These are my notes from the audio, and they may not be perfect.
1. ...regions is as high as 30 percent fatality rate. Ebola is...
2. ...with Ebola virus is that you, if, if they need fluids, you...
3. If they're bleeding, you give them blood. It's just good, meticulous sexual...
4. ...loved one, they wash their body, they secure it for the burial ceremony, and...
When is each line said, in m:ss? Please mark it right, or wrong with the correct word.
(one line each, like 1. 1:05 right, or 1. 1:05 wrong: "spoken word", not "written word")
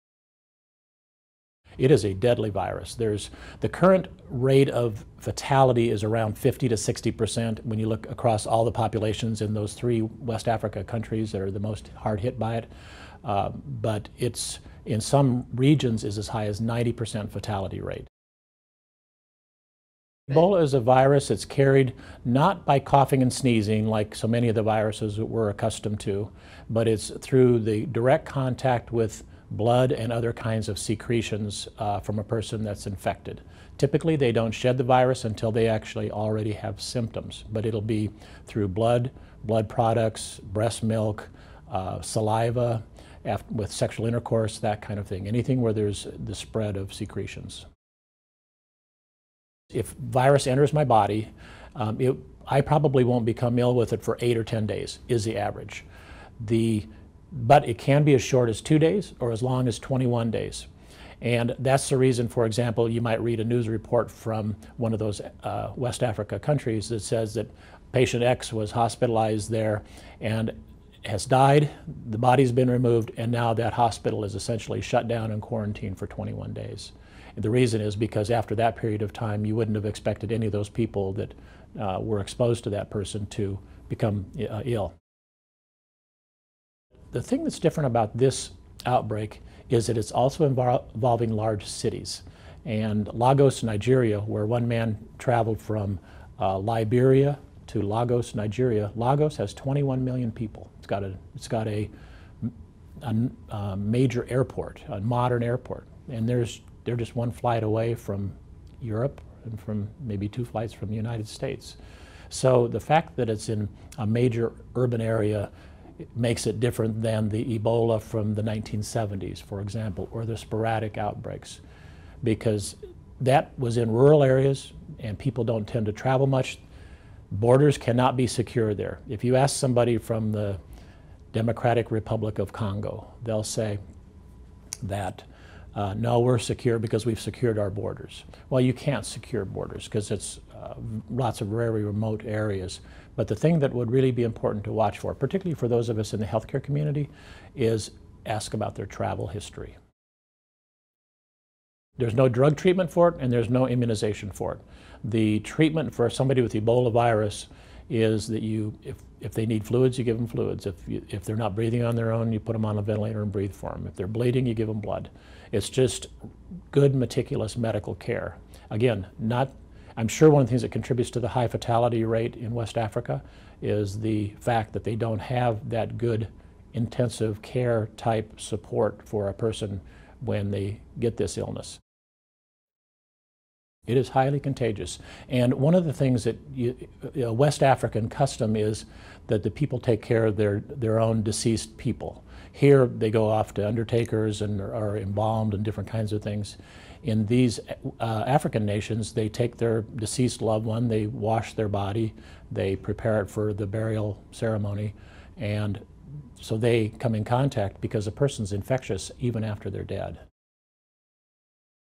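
1. 0:15 wrong: "90", not "30"
2. 2:36 right
3. 2:43 wrong: "medical", not "sexual"
4. 3:20 wrong: "prepare", not "secure".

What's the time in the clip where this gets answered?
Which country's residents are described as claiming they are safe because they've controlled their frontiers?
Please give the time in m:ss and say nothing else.
2:11.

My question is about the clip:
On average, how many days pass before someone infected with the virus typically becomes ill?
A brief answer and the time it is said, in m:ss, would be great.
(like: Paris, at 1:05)
8 or 10 days, at 0:54.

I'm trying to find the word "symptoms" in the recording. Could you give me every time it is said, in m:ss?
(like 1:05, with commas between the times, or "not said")
0:36.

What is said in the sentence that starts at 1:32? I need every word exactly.
And Lagos, Nigeria, where one man traveled from uh, Liberia to Lagos, Nigeria, Lagos has 21 million people.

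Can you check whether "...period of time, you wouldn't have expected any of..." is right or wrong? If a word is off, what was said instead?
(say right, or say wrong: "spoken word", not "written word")
right.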